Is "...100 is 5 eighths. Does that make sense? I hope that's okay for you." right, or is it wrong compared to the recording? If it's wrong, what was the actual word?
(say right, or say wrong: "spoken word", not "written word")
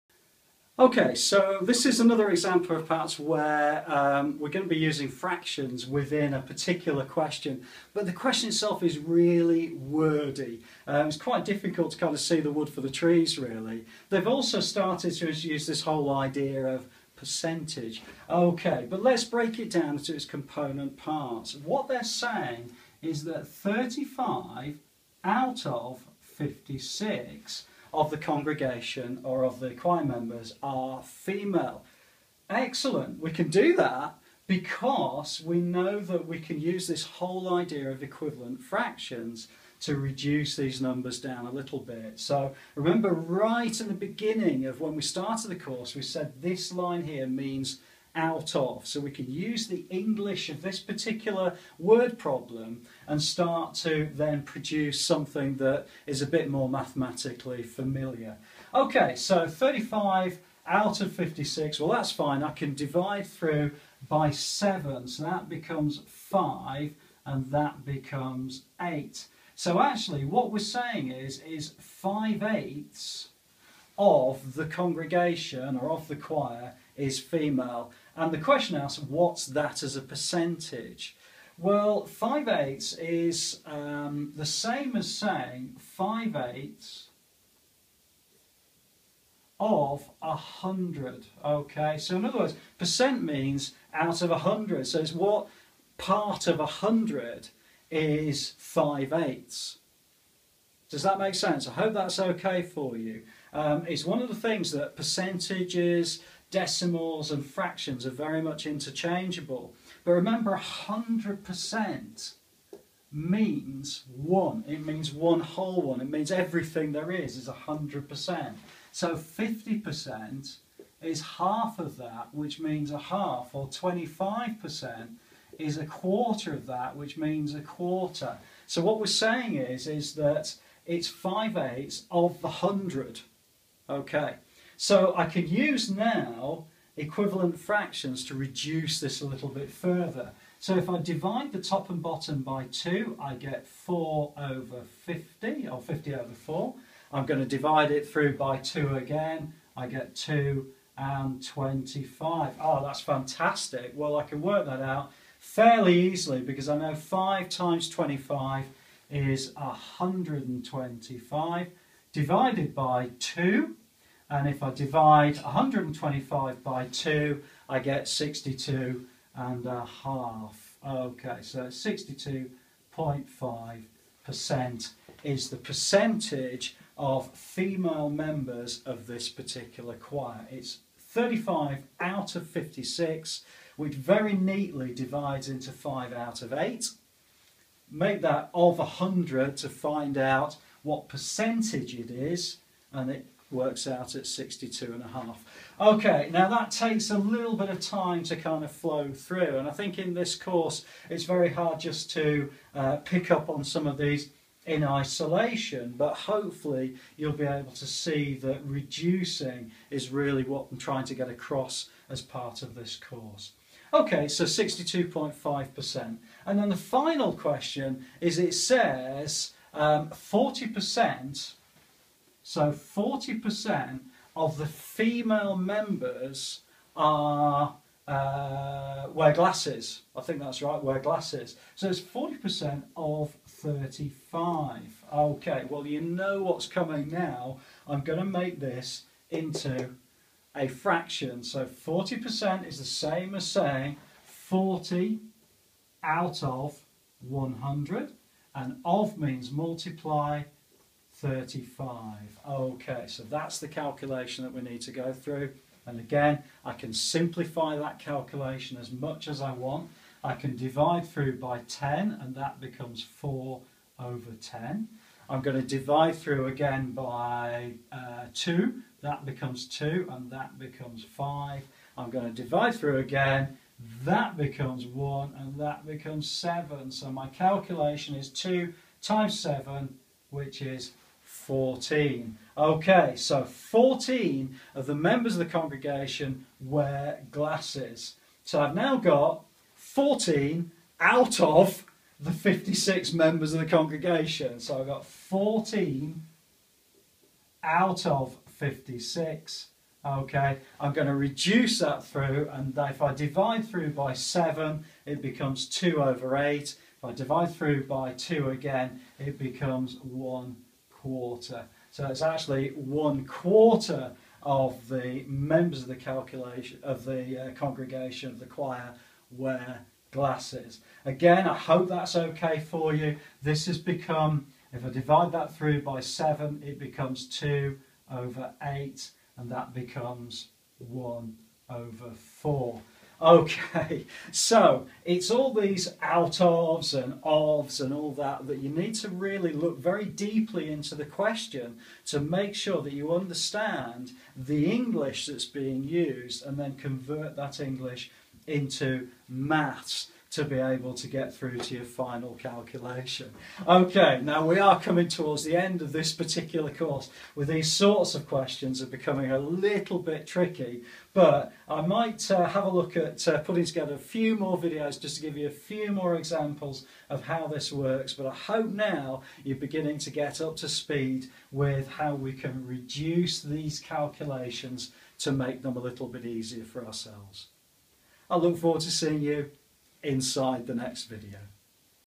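right.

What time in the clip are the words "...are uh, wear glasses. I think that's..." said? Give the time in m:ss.
3:46.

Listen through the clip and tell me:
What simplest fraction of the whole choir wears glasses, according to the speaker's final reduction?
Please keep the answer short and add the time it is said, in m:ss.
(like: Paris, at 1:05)
one quarter, at 5:10.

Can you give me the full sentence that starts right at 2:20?
So if I divide the top and bottom by 2, I get 4 over 50, or 50 over 4.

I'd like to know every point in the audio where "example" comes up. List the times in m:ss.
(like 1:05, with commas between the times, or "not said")
0:02, 6:06.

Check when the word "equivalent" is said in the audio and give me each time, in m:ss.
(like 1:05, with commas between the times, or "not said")
0:38, 2:16.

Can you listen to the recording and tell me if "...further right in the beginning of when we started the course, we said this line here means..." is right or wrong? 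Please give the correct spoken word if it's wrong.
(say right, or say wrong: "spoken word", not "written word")
wrong: "remember", not "further".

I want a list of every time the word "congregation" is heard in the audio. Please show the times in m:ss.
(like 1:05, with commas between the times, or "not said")
0:28, 1:14, 4:45, 4:53, 5:17.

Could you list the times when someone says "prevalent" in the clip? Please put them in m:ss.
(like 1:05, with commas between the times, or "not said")
not said.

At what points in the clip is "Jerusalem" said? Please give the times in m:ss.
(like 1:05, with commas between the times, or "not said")
not said.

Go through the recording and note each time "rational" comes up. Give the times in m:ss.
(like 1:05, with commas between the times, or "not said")
not said.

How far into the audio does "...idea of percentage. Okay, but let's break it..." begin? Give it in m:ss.
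0:16.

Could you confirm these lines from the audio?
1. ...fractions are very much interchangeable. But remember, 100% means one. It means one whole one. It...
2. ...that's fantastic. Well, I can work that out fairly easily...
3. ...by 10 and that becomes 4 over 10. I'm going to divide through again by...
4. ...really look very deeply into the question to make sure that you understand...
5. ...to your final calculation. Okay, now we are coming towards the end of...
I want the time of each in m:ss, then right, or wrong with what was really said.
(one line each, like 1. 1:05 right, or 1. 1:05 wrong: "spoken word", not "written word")
1. 1:47 right
2. 2:32 right
3. 4:21 right
4. 5:39 right
5. 5:51 right.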